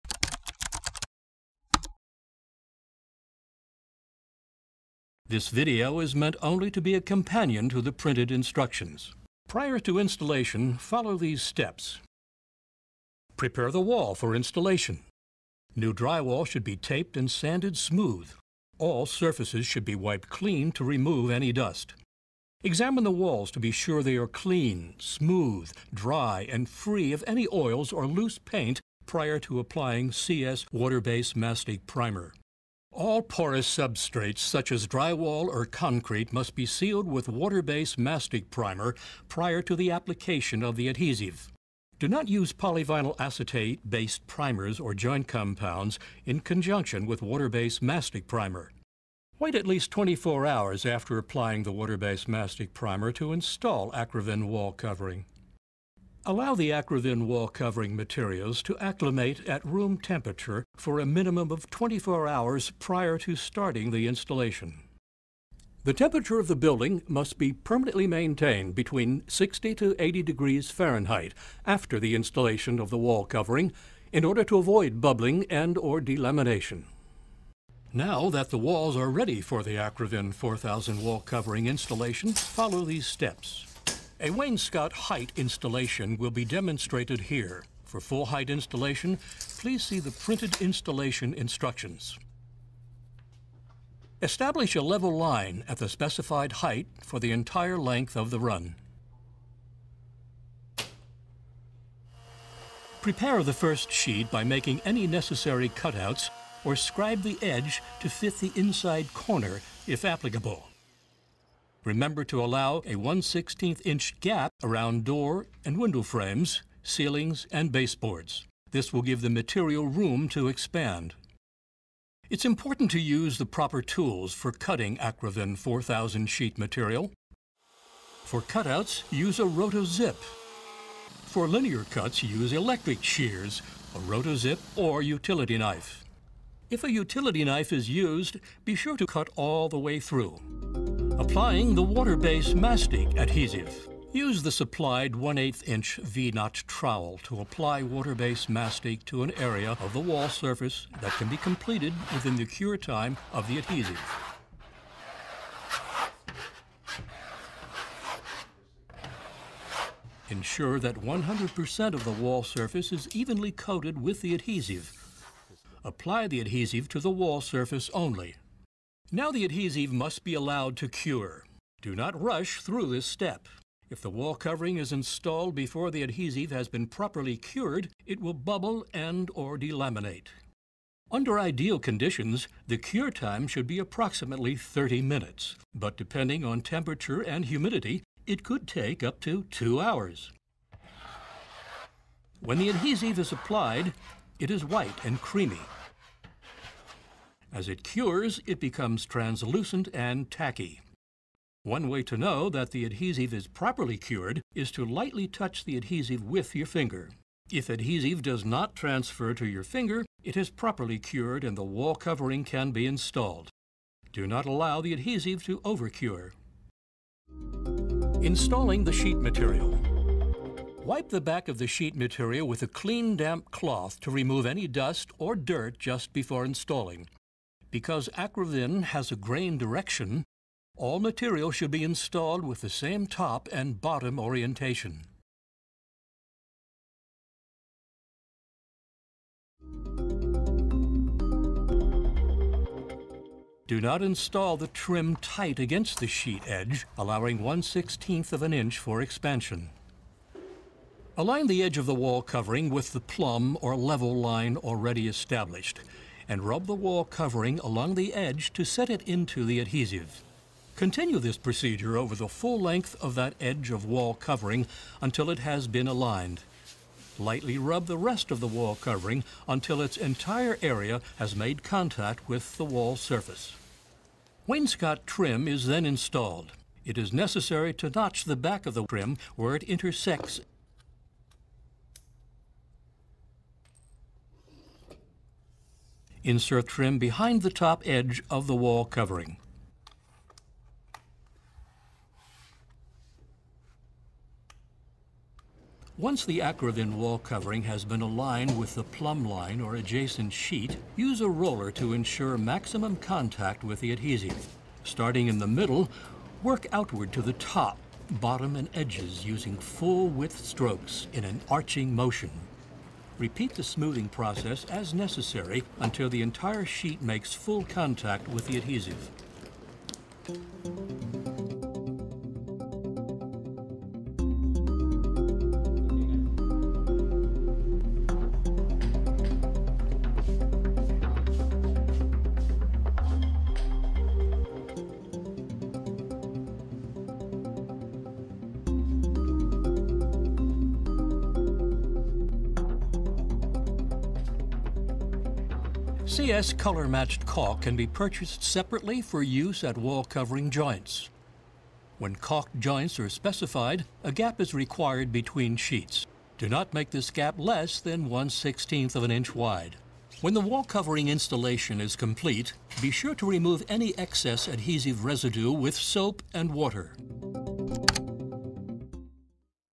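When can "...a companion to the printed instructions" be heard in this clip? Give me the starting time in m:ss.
0:06.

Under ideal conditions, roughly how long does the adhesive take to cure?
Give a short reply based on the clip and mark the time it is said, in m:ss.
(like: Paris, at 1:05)
30 minutes, at 3:04.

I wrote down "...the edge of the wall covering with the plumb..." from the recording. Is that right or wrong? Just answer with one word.
right.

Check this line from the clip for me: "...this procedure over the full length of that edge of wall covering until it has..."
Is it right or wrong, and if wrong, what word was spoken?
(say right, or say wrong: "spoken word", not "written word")
right.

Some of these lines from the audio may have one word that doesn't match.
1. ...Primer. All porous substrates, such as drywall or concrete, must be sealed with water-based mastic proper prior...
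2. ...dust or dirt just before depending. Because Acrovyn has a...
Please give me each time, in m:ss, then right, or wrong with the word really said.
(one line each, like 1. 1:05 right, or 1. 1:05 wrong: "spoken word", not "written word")
1. 0:31 wrong: "primer", not "proper"
2. 3:44 wrong: "installing", not "depending".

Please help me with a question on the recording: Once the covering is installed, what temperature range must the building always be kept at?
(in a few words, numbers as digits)
60 to 80 degrees Fahrenheit.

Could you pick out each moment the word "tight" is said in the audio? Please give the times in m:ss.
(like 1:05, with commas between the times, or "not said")
4:05.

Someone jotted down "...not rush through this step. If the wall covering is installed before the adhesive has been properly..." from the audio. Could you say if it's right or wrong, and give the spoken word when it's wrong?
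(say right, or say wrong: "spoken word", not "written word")
right.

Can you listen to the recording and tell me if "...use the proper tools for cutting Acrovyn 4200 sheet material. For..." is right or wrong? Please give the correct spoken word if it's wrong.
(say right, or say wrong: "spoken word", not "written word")
wrong: "4000", not "4200".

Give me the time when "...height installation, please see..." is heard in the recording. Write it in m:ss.
1:28.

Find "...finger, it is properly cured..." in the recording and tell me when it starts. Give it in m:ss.
3:29.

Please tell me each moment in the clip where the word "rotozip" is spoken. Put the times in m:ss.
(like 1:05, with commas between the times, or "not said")
2:09, 2:13.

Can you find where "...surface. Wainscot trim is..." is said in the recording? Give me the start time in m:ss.
4:32.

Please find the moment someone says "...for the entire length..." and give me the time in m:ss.
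1:37.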